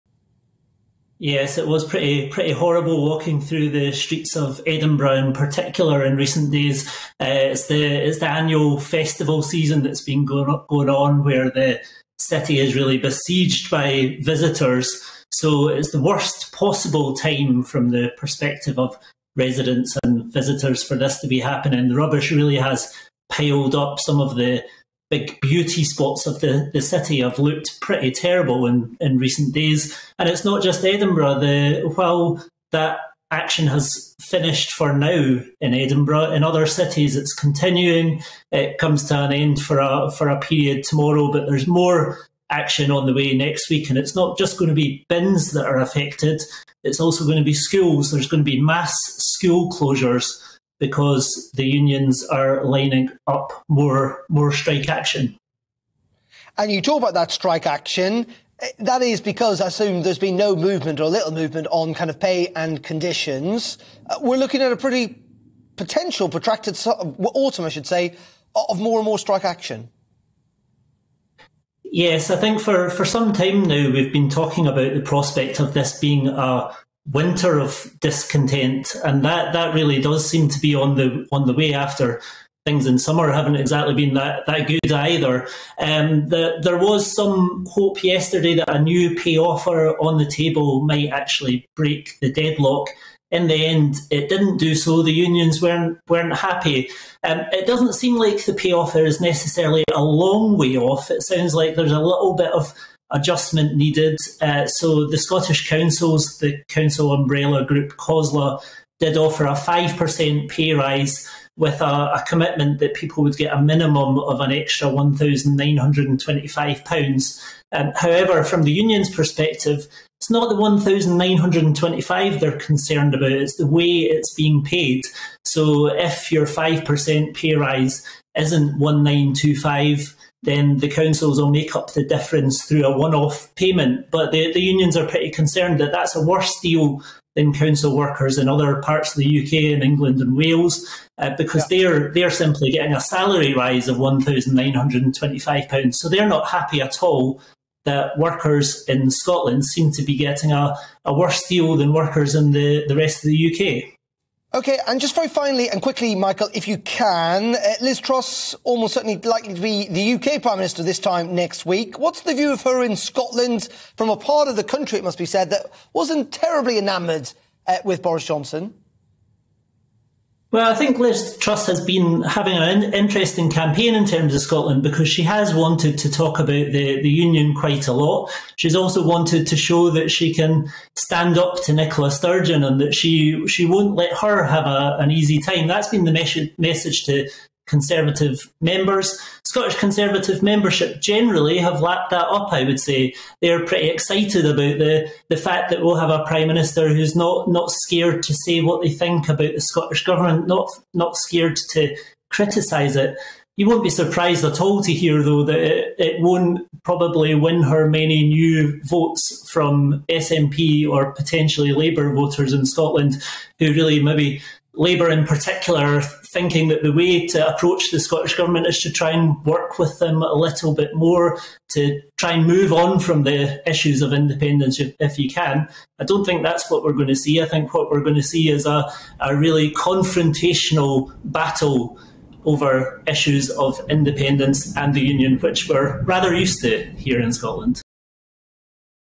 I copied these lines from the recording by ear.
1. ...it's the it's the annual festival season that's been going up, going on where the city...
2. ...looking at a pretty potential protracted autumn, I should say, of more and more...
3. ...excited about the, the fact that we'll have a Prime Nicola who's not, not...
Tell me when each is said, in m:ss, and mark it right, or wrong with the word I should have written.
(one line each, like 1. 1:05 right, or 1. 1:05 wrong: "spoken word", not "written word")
1. 0:07 right
2. 1:04 right
3. 3:13 wrong: "Minister", not "Nicola".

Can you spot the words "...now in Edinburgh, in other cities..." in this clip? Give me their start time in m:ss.
0:34.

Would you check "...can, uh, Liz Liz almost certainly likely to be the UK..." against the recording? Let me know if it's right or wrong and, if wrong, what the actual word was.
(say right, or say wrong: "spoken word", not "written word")
wrong: "Truss", not "Liz".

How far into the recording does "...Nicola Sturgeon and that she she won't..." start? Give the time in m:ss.
3:01.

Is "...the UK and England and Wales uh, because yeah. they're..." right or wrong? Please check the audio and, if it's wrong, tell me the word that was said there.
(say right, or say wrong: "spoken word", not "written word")
right.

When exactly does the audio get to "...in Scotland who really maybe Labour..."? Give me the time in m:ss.
3:32.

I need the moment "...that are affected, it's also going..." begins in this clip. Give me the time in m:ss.
0:45.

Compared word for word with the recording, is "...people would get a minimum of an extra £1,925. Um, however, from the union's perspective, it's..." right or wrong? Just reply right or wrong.
right.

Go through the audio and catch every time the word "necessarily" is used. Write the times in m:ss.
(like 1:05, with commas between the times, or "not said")
1:39.